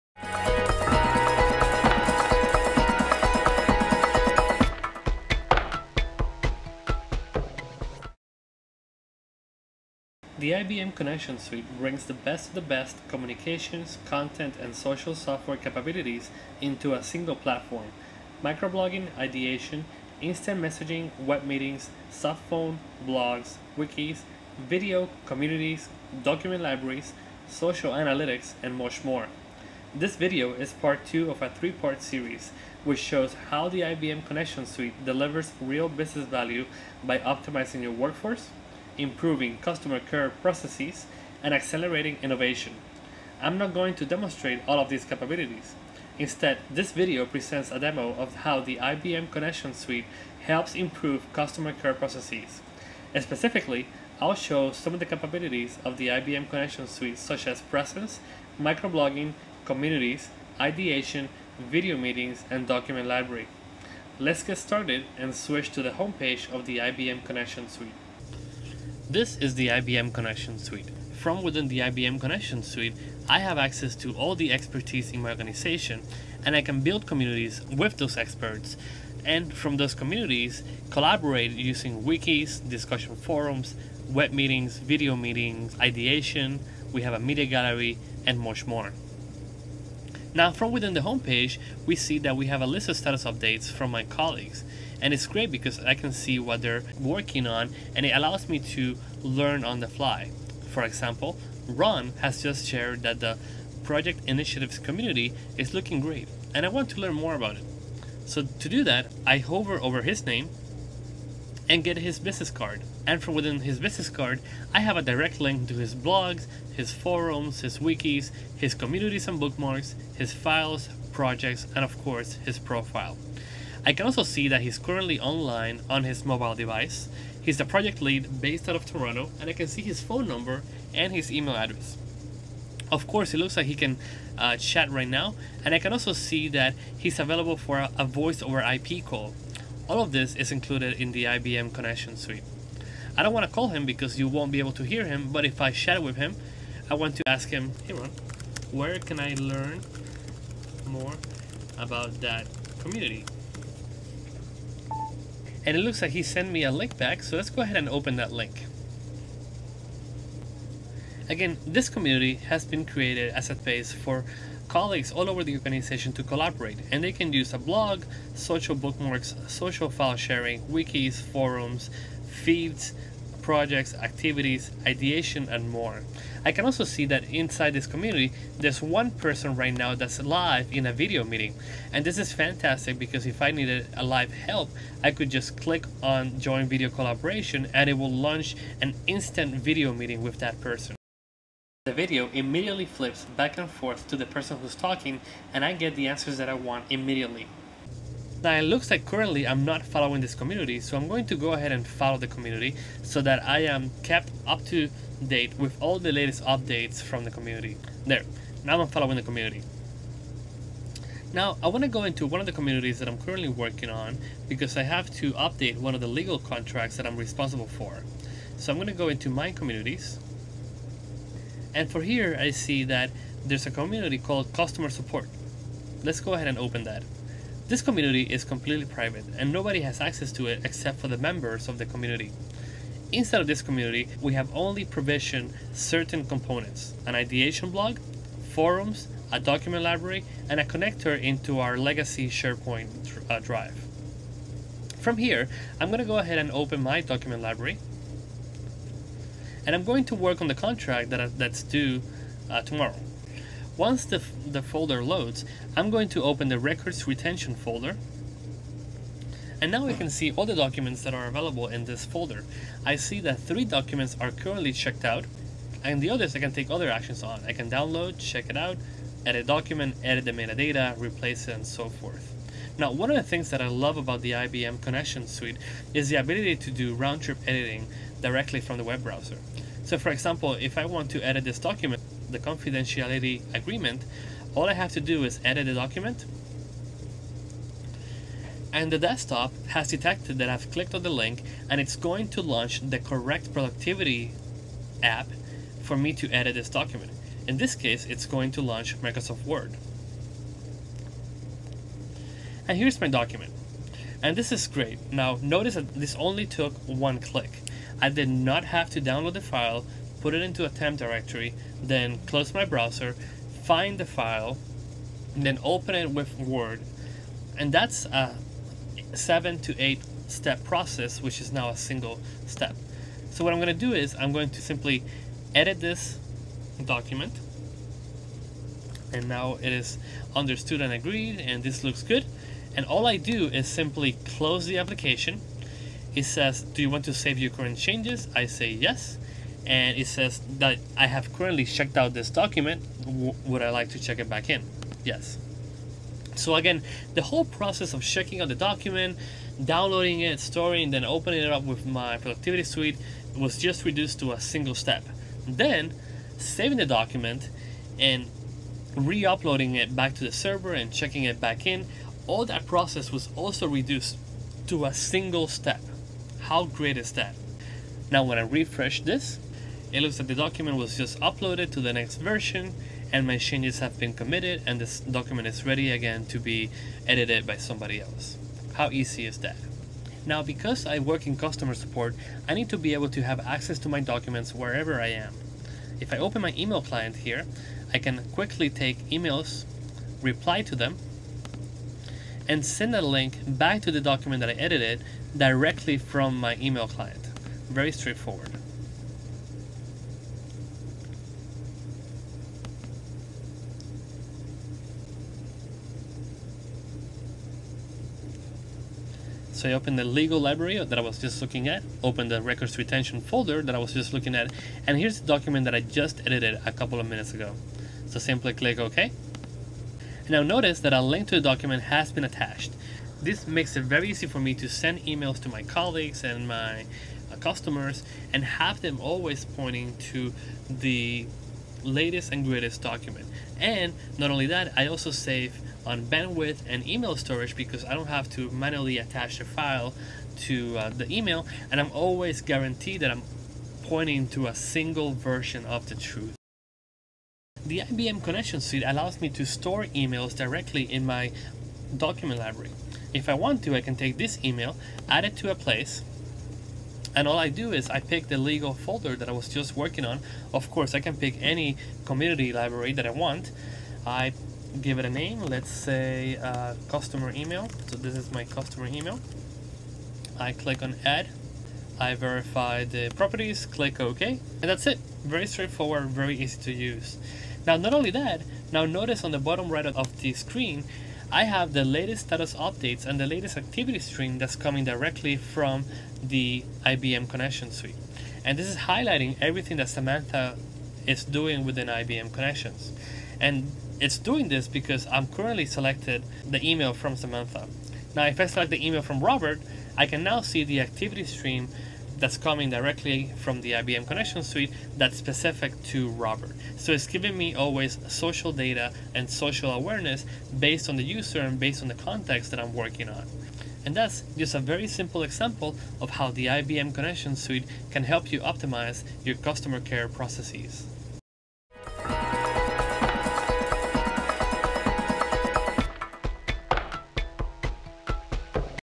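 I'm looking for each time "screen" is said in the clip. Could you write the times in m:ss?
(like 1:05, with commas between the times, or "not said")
8:00.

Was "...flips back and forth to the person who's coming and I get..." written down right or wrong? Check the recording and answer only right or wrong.
wrong.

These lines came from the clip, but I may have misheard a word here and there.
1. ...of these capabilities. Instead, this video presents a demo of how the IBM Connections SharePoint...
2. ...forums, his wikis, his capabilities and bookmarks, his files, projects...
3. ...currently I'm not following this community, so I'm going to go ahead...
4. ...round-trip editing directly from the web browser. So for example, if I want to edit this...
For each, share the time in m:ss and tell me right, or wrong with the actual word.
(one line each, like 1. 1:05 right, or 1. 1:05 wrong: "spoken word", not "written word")
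1. 0:44 wrong: "Suite", not "SharePoint"
2. 1:56 wrong: "communities", not "capabilities"
3. 3:19 right
4. 4:36 right.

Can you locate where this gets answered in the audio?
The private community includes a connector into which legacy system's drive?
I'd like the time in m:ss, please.
4:02.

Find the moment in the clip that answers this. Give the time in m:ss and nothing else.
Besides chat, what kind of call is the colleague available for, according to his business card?
2:18.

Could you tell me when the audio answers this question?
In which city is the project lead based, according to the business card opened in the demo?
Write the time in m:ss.
2:08.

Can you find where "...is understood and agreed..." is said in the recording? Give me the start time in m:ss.
5:29.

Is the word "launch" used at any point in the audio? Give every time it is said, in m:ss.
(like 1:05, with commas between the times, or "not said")
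3:08, 4:52, 4:58.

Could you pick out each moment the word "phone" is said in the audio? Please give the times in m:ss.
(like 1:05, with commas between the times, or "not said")
0:22, 2:10.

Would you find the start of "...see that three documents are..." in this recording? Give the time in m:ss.
4:22.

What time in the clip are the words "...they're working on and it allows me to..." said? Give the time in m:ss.
1:36.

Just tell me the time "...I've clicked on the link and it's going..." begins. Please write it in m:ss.
4:50.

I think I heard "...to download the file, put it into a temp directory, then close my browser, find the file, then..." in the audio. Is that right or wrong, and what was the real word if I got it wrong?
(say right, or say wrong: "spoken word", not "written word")
right.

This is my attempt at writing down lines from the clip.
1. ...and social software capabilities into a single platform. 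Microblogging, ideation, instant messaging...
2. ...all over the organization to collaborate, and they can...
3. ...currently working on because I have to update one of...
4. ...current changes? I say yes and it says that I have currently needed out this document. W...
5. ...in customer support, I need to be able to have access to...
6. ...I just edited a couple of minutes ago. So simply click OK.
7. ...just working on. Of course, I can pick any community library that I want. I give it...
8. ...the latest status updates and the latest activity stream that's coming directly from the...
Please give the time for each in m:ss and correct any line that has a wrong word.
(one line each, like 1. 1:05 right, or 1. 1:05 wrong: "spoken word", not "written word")
1. 0:14 right
2. 2:45 right
3. 3:33 right
4. 5:37 wrong: "checked", not "needed"
5. 6:21 right
6. 6:55 right
7. 7:39 right
8. 8:01 right.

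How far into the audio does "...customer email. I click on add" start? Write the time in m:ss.
7:48.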